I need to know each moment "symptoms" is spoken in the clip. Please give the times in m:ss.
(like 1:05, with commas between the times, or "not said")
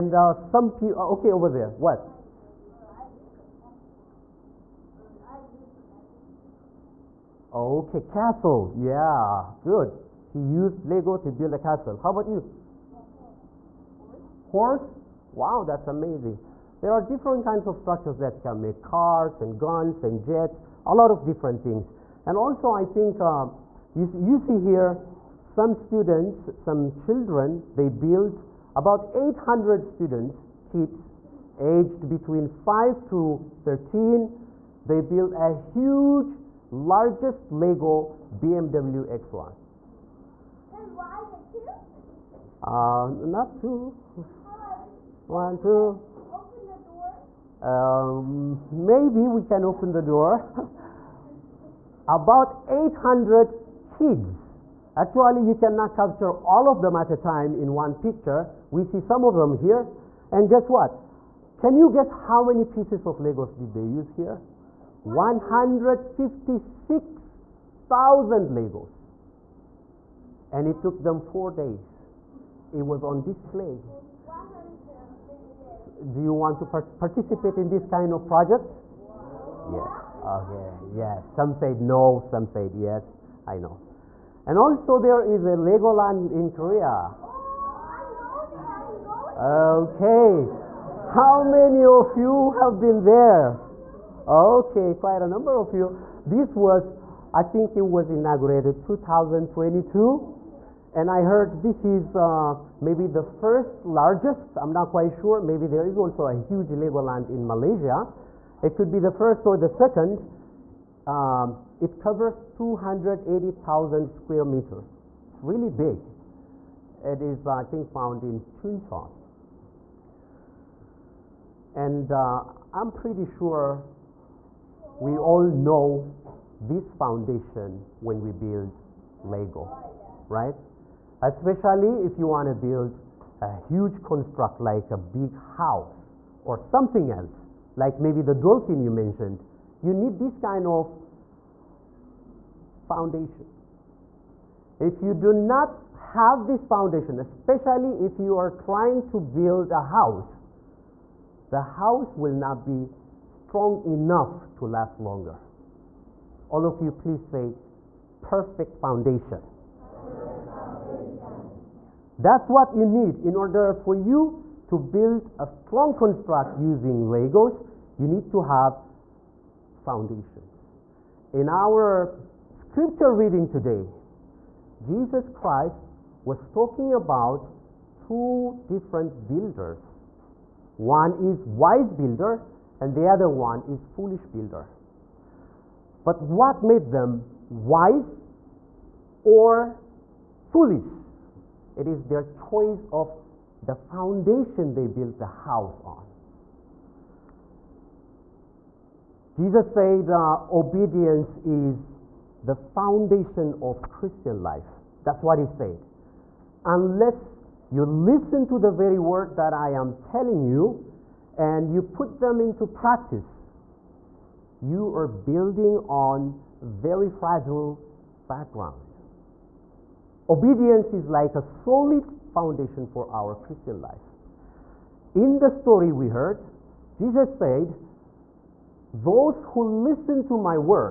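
not said.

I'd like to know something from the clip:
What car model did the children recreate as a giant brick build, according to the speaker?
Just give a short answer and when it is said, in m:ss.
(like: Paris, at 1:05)
BMW X1, at 0:38.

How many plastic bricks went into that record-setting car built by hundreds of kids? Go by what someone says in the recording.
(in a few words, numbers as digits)
156,000.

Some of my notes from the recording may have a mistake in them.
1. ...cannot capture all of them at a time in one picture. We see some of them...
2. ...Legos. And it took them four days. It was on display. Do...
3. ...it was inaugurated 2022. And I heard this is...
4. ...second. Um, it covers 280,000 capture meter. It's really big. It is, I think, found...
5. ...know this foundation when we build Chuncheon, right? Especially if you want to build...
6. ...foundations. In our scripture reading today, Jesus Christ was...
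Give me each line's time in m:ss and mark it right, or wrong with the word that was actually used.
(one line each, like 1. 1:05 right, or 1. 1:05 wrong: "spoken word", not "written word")
1. 0:55 right
2. 1:08 right
3. 1:37 right
4. 1:49 wrong: "square", not "capture"
5. 2:05 wrong: "Lego", not "Chuncheon"
6. 2:49 right.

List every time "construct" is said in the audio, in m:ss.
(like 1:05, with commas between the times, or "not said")
2:14, 2:45.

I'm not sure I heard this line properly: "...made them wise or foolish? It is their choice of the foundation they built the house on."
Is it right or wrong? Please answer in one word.
right.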